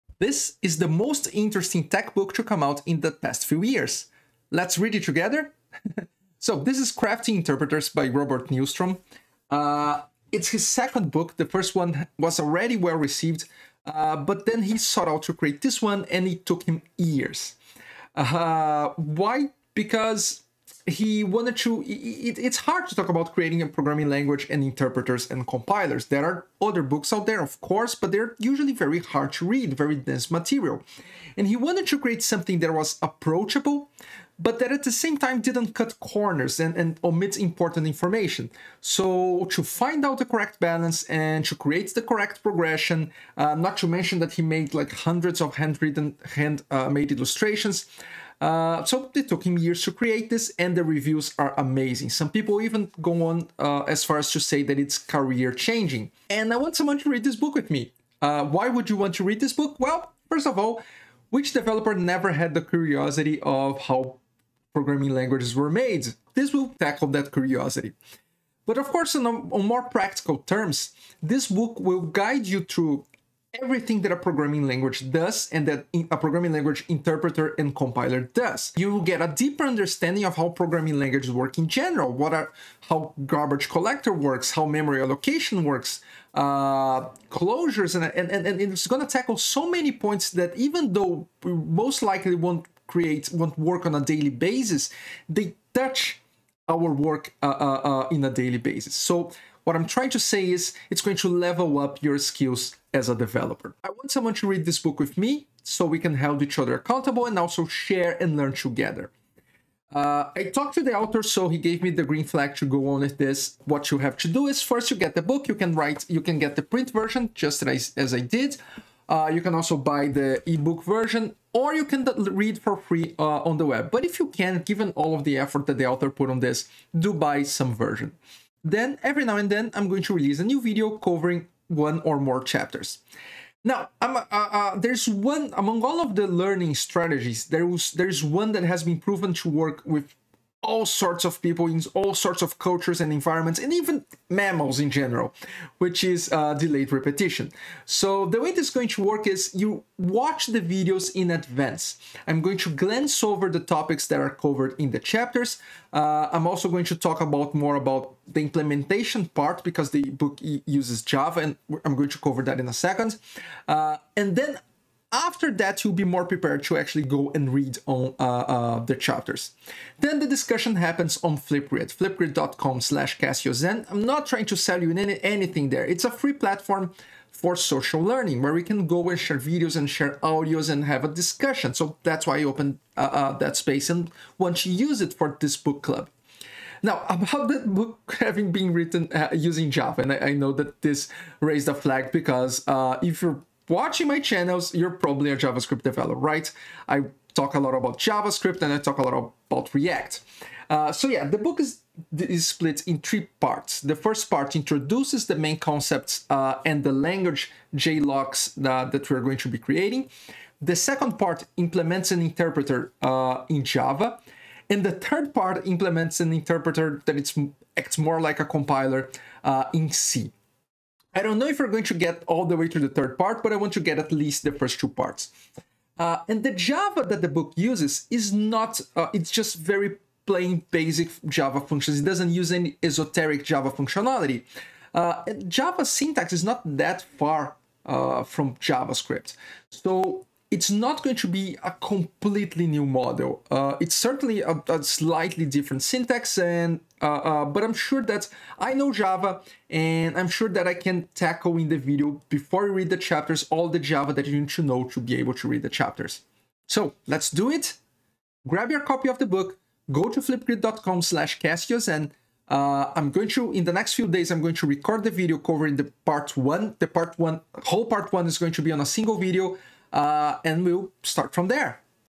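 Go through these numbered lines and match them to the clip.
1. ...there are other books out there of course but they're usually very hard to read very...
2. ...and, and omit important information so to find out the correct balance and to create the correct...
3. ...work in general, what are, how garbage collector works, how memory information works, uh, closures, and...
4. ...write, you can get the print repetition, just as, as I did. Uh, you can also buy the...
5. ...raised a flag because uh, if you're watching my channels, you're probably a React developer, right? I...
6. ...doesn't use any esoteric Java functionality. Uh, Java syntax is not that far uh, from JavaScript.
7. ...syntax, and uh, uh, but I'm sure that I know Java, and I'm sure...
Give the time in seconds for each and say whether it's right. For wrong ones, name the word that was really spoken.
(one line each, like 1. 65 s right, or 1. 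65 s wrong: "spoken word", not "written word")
1. 26 s right
2. 36 s right
3. 81 s wrong: "allocation", not "information"
4. 115 s wrong: "version", not "repetition"
5. 191 s wrong: "JavaScript", not "React"
6. 232 s right
7. 245 s right.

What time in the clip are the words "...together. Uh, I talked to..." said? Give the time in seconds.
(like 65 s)
108 s.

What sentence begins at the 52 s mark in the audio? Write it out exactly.
Some people even go on uh, as far as to say that it's career changing.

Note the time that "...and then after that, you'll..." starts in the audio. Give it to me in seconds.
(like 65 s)
164 s.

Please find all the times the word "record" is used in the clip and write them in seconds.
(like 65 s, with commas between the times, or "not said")
264 s.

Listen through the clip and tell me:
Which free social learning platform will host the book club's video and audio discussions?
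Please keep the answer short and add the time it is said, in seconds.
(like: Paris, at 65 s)
Flipgrid, at 171 s.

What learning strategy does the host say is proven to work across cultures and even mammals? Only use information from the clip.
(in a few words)
Delayed repetition.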